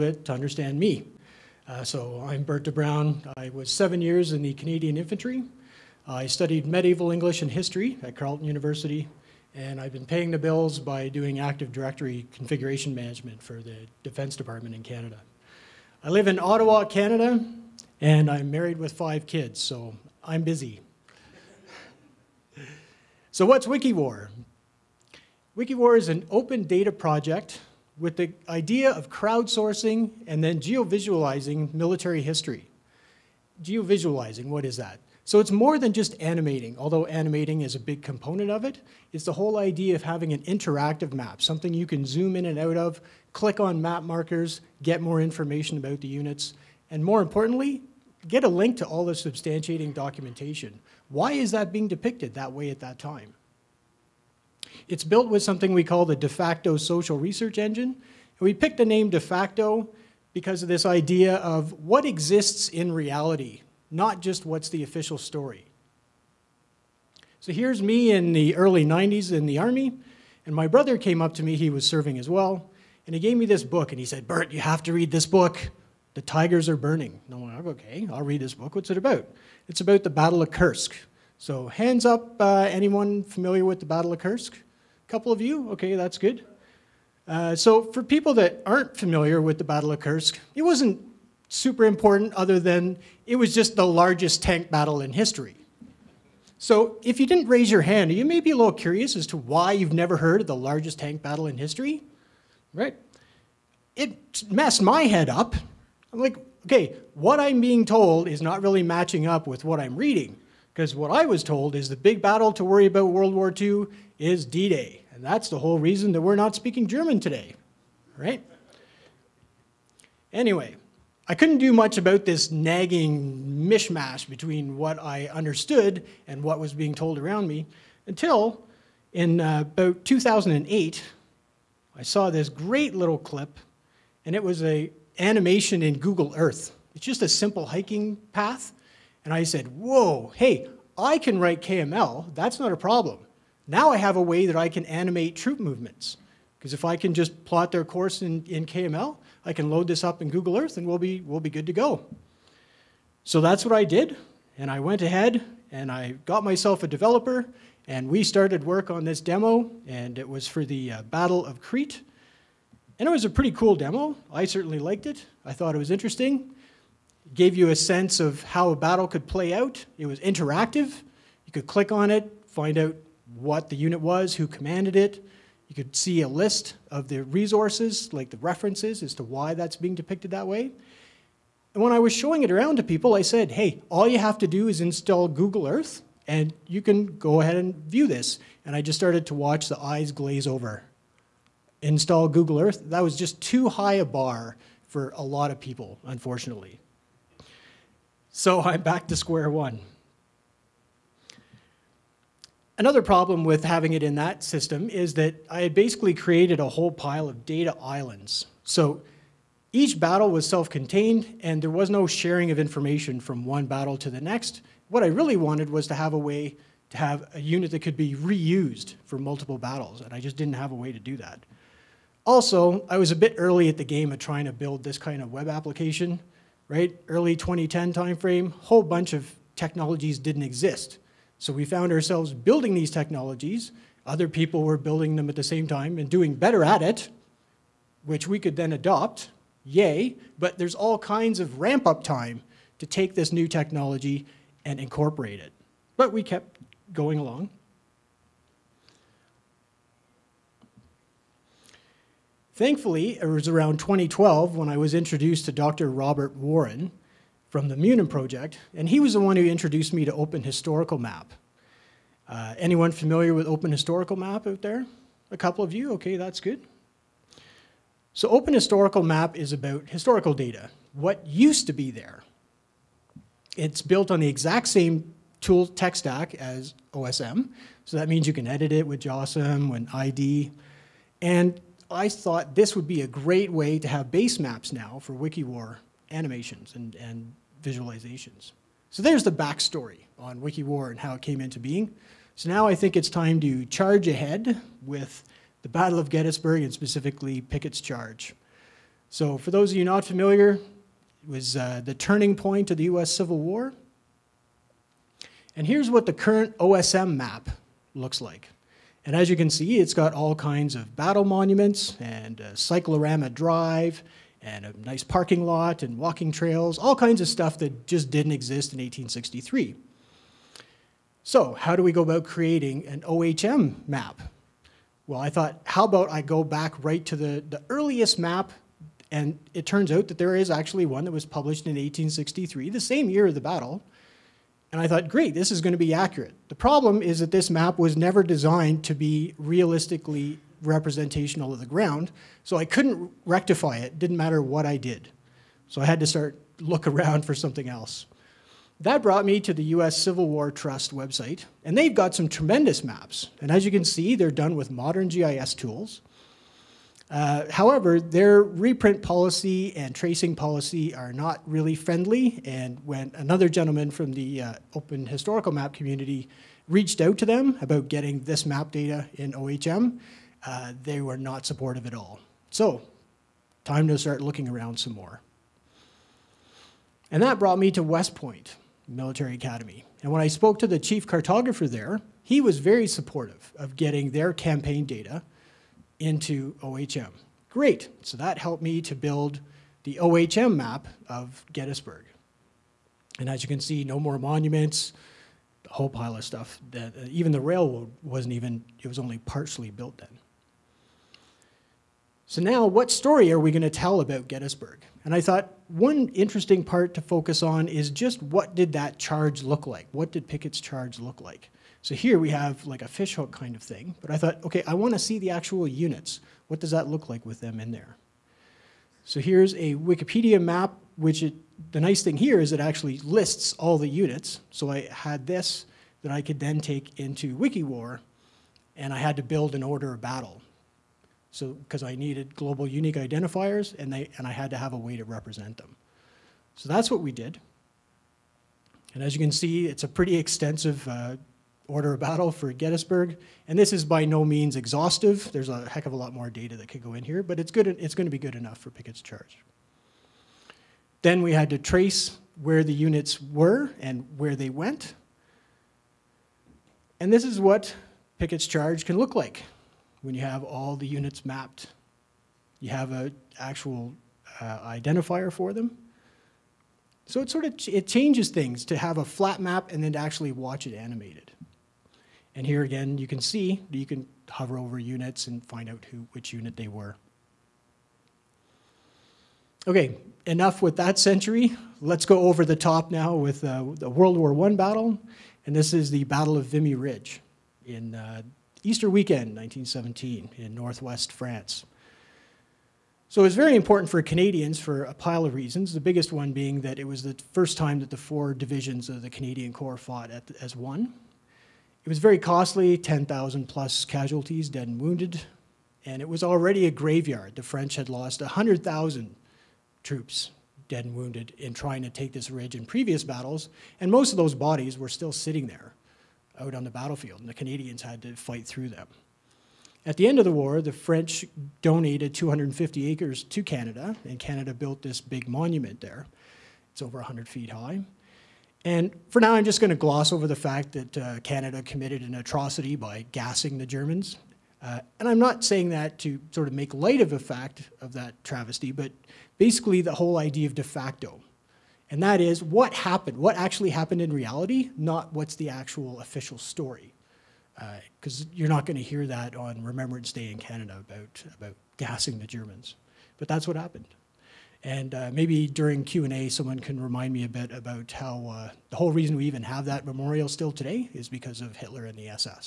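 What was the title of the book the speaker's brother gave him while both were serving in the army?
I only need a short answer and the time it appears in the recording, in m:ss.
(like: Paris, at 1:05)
The Tigers Are Burning, at 1:16.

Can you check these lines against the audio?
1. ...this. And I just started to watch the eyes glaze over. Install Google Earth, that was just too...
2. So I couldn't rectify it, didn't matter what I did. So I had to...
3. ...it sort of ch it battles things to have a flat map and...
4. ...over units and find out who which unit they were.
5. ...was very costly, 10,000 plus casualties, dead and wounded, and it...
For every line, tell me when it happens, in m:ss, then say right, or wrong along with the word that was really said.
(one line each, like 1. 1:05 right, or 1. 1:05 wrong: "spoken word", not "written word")
1. 3:08 right
2. 5:42 right
3. 7:47 wrong: "changes", not "battles"
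4. 7:54 right
5. 8:21 right.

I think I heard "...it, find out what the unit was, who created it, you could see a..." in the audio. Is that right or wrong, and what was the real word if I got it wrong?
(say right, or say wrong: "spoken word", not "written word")
wrong: "commanded", not "created".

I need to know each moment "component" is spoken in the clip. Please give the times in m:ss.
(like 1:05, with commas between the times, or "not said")
0:38.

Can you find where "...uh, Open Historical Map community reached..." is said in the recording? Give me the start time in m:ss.
6:04.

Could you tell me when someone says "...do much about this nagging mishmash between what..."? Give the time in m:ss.
2:01.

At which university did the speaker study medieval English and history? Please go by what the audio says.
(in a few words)
Carleton University.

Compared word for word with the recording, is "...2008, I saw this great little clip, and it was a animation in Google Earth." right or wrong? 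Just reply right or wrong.
right.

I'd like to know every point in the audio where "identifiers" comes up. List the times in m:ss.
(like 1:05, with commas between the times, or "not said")
7:12, 7:44.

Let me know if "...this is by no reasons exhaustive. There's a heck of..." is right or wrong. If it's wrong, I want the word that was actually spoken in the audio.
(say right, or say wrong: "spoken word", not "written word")
wrong: "means", not "reasons".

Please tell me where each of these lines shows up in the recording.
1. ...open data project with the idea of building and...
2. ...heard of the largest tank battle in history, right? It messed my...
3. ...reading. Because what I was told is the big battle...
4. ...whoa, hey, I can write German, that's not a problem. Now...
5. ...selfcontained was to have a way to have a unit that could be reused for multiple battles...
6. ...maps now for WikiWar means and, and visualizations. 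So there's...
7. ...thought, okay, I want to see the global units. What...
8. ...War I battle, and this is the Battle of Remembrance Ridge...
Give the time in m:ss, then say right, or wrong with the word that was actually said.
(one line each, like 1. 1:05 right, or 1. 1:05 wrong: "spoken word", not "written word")
1. 0:26 wrong: "crowdsourcing", not "building"
2. 1:40 right
3. 1:49 right
4. 2:19 wrong: "KML", not "German"
5. 3:35 wrong: "wanted", not "selfcontained"
6. 4:44 wrong: "animations", not "means"
7. 6:54 wrong: "actual", not "global"
8. 8:04 wrong: "Vimy", not "Remembrance".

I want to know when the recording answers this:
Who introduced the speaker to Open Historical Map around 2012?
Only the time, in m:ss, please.
4:15.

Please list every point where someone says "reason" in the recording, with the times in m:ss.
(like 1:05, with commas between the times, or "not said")
1:55, 8:15, 9:18.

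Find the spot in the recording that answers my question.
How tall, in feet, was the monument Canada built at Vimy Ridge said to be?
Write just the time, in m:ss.
8:46.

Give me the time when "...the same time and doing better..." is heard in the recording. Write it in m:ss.
3:55.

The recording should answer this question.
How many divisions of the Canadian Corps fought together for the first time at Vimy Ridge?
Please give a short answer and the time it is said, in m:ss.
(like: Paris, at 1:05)
4, at 8:17.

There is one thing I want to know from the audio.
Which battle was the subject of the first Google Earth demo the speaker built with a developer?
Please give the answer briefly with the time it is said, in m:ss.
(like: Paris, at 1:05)
Battle of Crete, at 2:41.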